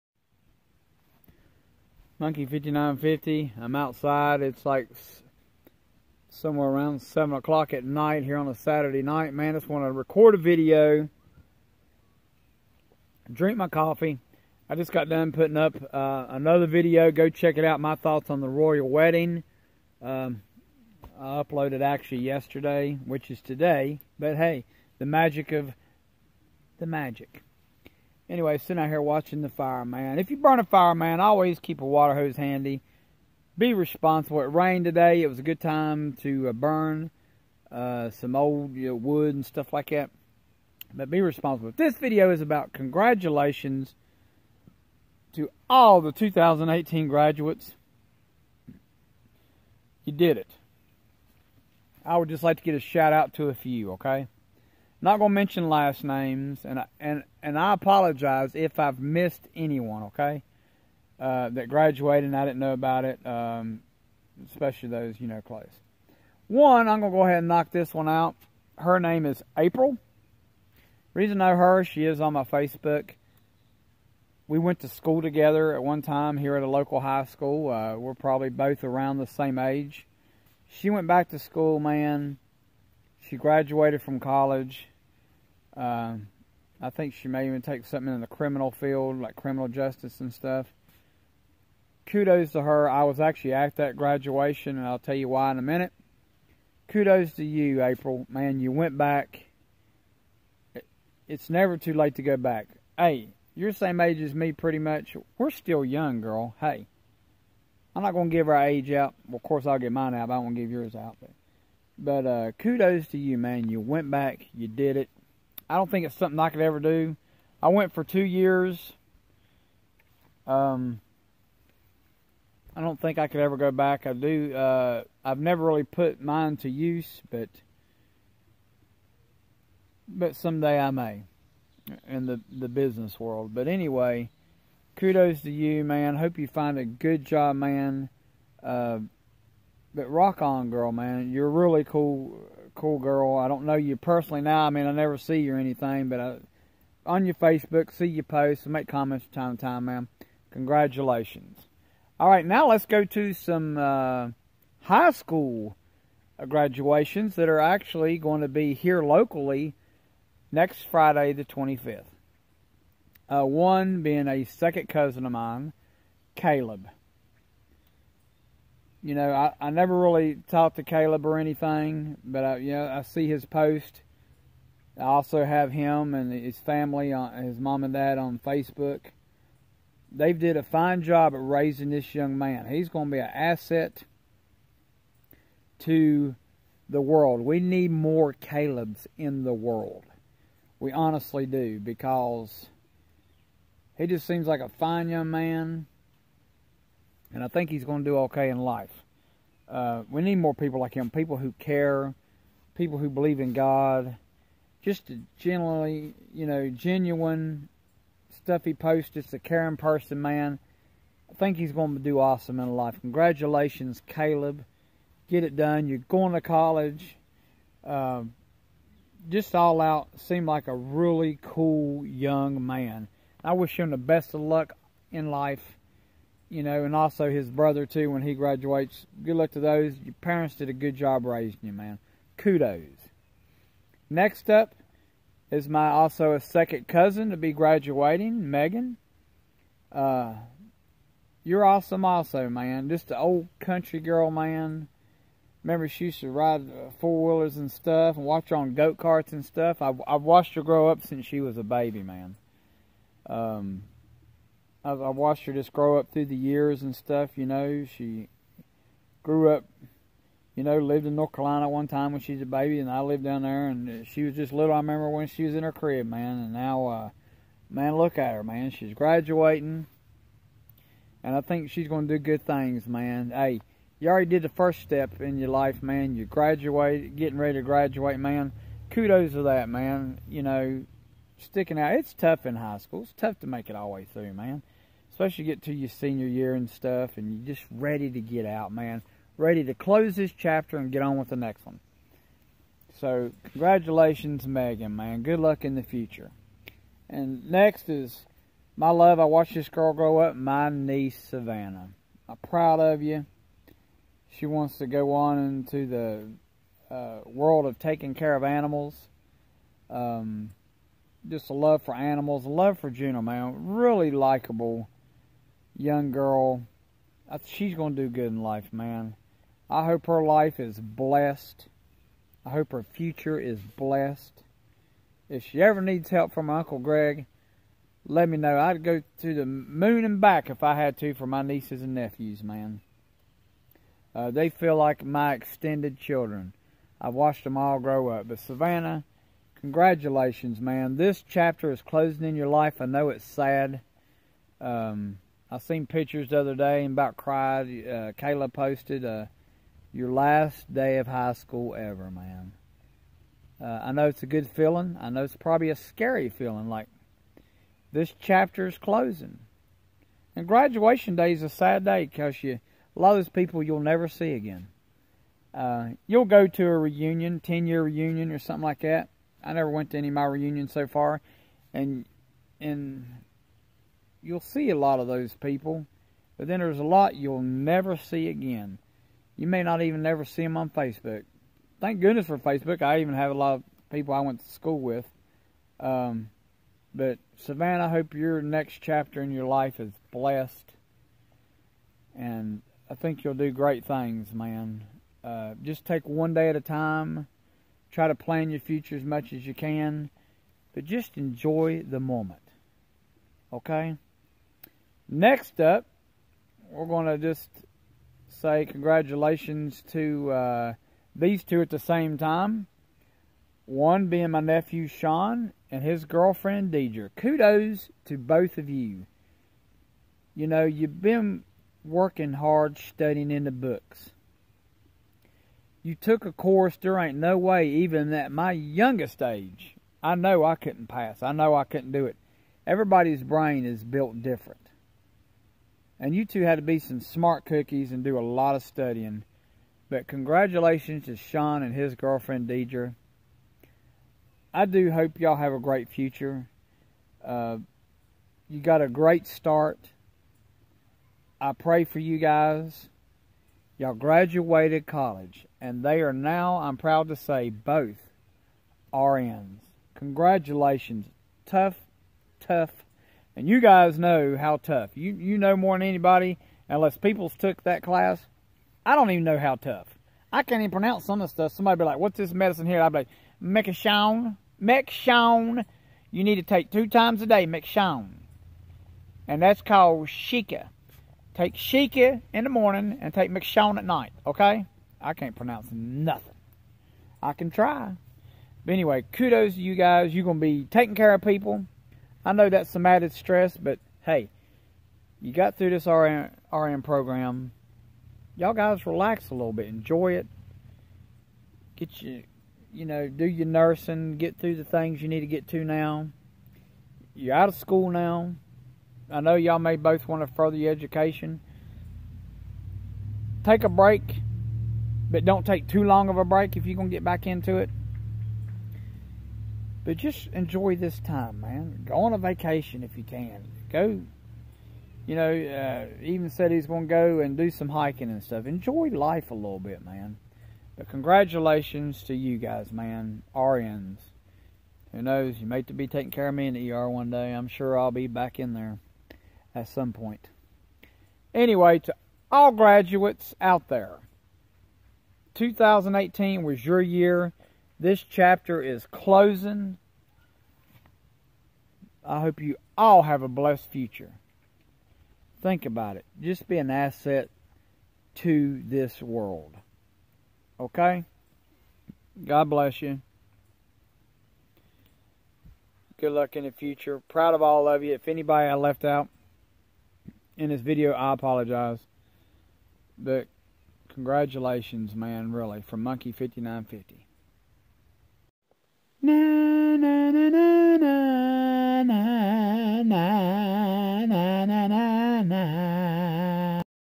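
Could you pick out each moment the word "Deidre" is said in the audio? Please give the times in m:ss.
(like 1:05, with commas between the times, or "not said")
6:56, 7:22.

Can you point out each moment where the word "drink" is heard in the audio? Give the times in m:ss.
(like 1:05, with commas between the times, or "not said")
0:13.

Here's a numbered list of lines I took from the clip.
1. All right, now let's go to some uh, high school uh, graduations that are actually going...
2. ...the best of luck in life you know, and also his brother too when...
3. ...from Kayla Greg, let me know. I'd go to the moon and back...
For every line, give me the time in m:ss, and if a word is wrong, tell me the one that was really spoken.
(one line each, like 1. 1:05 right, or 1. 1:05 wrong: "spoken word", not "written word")
1. 2:32 right
2. 3:43 right
3. 5:26 wrong: "Uncle", not "Kayla".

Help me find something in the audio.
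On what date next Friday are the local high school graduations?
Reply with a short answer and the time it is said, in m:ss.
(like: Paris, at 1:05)
The 25th, at 2:41.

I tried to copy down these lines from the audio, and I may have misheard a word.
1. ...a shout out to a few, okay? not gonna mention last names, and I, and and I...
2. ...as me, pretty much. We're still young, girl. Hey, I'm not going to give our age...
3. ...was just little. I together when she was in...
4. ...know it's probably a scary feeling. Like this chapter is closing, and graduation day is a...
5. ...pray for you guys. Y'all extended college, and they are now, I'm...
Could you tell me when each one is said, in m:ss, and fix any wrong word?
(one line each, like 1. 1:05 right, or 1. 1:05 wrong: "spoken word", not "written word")
1. 0:52 right
2. 1:44 right
3. 4:24 wrong: "remember", not "together"
4. 5:55 right
5. 7:31 wrong: "graduated", not "extended".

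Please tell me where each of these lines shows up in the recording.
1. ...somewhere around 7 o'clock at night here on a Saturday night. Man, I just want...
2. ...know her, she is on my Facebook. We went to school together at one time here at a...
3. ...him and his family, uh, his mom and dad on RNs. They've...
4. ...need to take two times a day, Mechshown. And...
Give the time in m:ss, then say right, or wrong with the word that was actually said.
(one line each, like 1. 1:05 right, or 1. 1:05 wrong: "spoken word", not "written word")
1. 0:06 right
2. 1:11 right
3. 2:55 wrong: "Facebook", not "RNs"
4. 7:56 right.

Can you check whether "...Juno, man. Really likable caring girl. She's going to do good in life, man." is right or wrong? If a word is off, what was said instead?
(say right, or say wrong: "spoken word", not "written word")
wrong: "young", not "caring".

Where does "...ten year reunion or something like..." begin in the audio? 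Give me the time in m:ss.
6:07.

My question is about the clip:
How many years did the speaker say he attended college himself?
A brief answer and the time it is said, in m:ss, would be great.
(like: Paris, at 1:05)
2, at 1:58.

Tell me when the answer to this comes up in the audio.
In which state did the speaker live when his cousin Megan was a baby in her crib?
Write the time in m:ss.
4:21.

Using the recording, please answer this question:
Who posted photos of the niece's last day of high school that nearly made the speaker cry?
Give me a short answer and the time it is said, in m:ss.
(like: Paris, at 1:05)
Kayla, at 5:48.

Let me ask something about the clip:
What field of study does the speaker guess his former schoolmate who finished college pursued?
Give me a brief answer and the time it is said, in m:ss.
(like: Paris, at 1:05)
Criminal justice, at 1:29.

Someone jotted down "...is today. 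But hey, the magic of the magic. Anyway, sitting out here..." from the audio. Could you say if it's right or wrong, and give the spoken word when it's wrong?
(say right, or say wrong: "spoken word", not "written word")
right.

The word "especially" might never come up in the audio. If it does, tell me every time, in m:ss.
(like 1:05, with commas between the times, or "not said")
1:04, 4:45.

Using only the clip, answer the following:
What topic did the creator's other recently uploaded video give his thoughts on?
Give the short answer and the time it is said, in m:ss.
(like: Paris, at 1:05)
The royal wedding, at 0:18.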